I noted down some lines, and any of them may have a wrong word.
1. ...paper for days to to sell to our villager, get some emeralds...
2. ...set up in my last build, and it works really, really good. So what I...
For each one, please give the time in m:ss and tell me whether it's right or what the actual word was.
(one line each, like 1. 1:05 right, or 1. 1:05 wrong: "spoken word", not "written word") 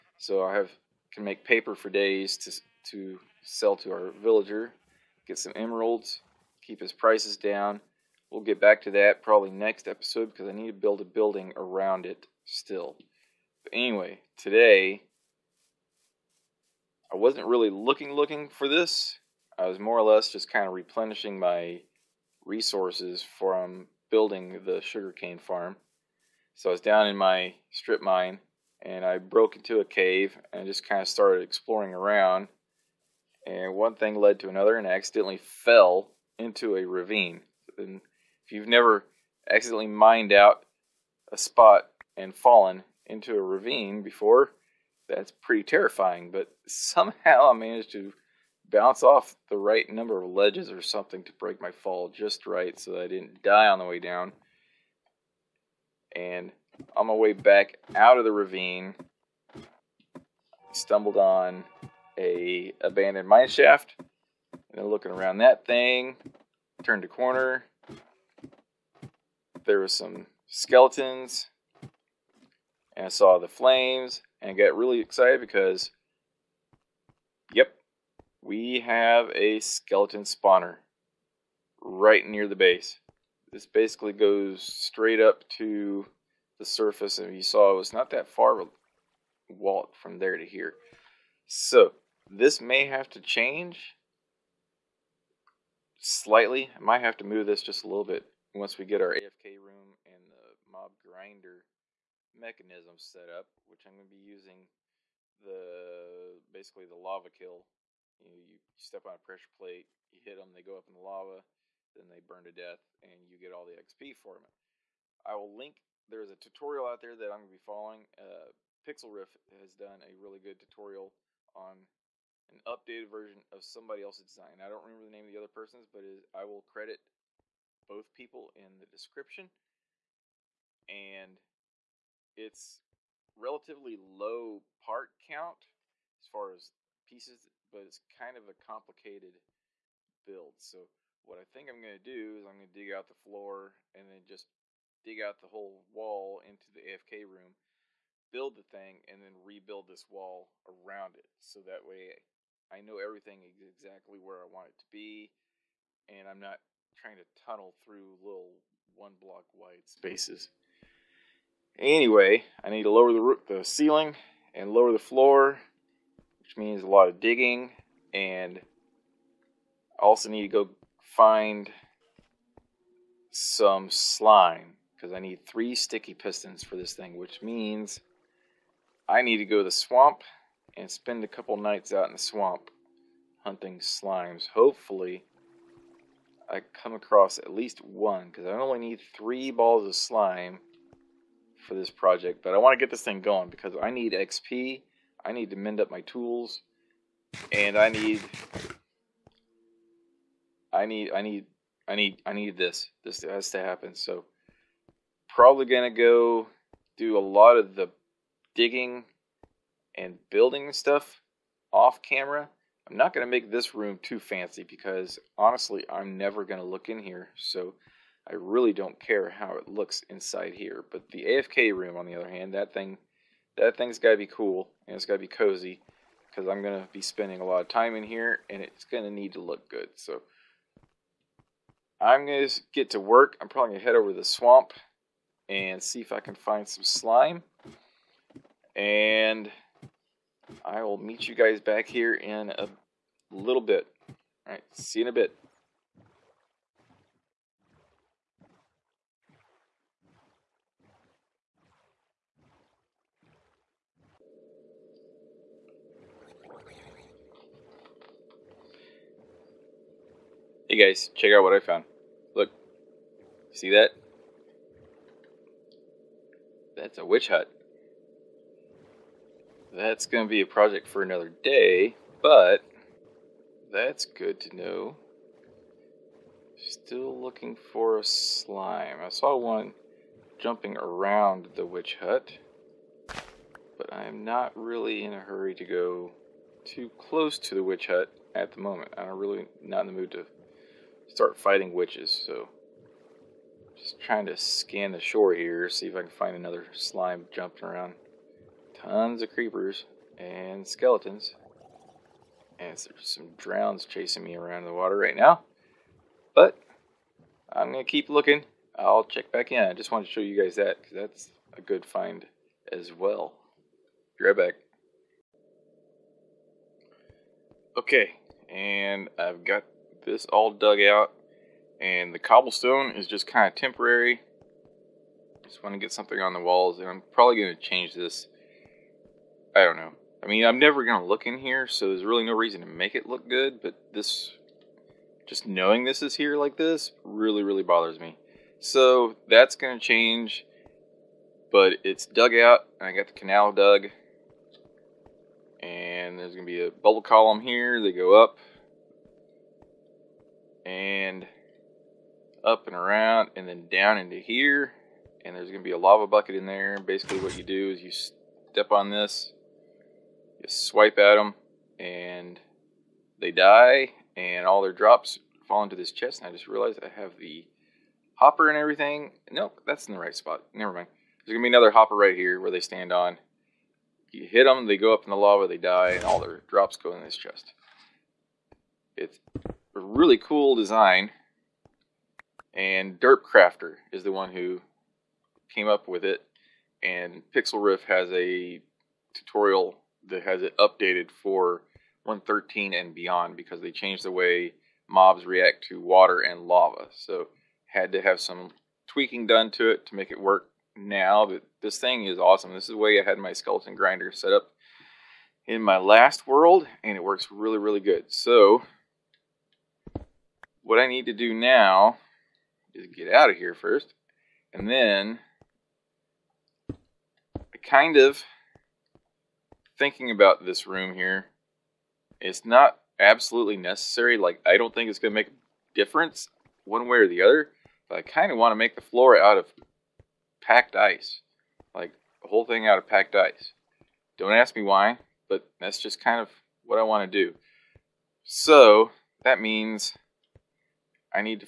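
1. 0:01 right
2. 6:44 wrong: "world", not "build".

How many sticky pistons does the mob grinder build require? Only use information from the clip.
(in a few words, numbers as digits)
3.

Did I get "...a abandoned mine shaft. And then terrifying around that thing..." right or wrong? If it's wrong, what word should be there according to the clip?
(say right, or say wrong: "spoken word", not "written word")
wrong: "looking", not "terrifying".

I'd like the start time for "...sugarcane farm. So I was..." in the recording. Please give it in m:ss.
0:24.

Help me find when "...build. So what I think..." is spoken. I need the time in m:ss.
2:20.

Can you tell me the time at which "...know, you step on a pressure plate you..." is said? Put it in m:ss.
1:48.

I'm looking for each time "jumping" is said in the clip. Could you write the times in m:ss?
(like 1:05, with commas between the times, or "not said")
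4:40, 4:57.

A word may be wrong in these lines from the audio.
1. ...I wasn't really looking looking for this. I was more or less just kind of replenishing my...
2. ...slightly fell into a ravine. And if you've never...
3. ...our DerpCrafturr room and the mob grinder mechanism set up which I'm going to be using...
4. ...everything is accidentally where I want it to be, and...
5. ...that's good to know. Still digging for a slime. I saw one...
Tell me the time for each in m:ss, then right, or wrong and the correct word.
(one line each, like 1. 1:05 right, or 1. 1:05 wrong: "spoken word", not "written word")
1. 0:17 right
2. 0:34 wrong: "accidentally", not "slightly"
3. 1:39 wrong: "AFK", not "DerpCrafturr"
4. 2:32 wrong: "exactly", not "accidentally"
5. 4:33 wrong: "looking", not "digging".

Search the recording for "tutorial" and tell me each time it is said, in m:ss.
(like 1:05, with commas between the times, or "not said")
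1:56, 2:00, 6:29.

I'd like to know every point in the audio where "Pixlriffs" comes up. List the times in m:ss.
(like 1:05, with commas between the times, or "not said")
1:58, 6:27.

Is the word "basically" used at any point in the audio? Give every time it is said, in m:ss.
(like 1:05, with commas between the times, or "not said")
1:23, 1:46, 5:56.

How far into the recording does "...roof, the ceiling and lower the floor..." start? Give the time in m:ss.
2:43.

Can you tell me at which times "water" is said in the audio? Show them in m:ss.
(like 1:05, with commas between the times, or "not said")
5:04, 6:35.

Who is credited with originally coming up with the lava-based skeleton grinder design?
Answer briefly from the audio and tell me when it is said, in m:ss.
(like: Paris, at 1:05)
DerpCrafturr, at 6:22.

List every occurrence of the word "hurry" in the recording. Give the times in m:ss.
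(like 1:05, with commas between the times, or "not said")
4:45.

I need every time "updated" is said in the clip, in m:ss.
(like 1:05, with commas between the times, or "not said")
2:02, 6:30.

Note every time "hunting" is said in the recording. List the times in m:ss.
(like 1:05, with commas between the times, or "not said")
3:03.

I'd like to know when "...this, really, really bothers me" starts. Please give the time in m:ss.
5:36.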